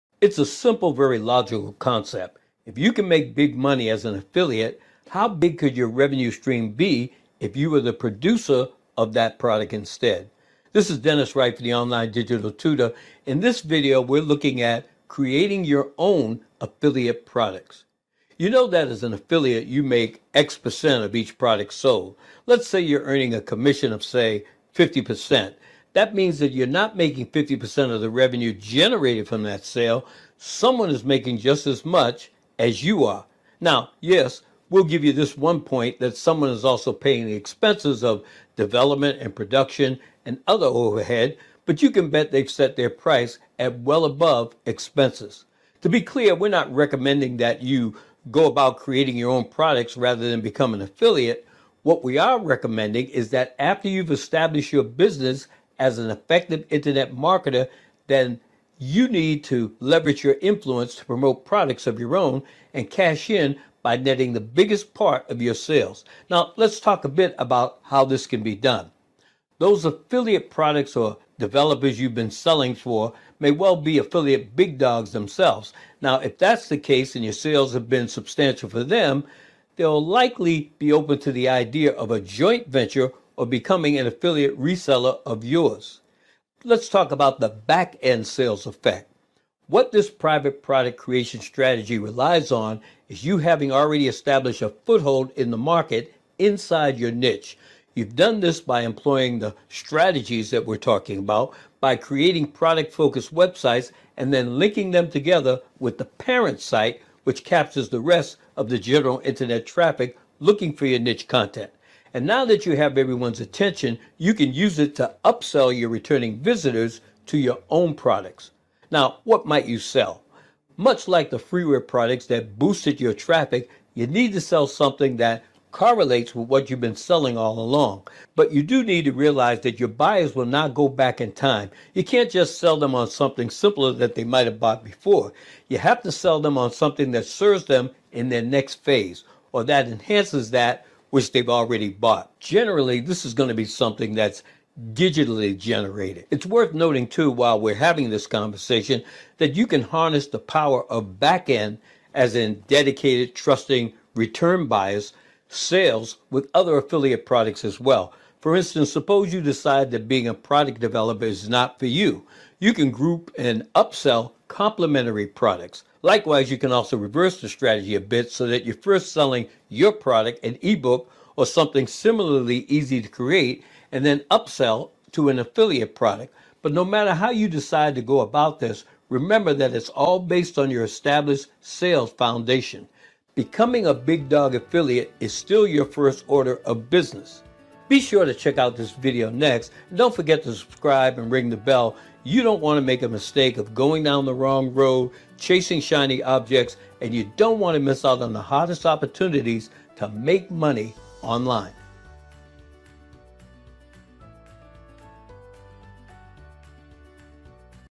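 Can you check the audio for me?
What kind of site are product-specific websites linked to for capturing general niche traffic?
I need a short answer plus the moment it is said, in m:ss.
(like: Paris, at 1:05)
the parent site, at 1:46.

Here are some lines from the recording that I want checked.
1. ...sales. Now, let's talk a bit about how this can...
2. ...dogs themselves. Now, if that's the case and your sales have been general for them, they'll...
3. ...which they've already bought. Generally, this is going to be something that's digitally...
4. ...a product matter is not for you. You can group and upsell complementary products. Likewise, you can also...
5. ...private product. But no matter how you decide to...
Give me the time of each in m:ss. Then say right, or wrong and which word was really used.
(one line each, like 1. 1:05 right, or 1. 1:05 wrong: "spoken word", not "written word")
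1. 1:05 right
2. 1:14 wrong: "substantial", not "general"
3. 2:21 right
4. 2:40 wrong: "developer", not "matter"
5. 2:55 wrong: "affiliate", not "private".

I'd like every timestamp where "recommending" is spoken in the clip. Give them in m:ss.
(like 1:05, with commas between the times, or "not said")
0:46, 0:52.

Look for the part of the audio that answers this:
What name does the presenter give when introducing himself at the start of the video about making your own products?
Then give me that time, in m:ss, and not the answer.
0:10.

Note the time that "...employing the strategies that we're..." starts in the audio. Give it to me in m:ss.
1:38.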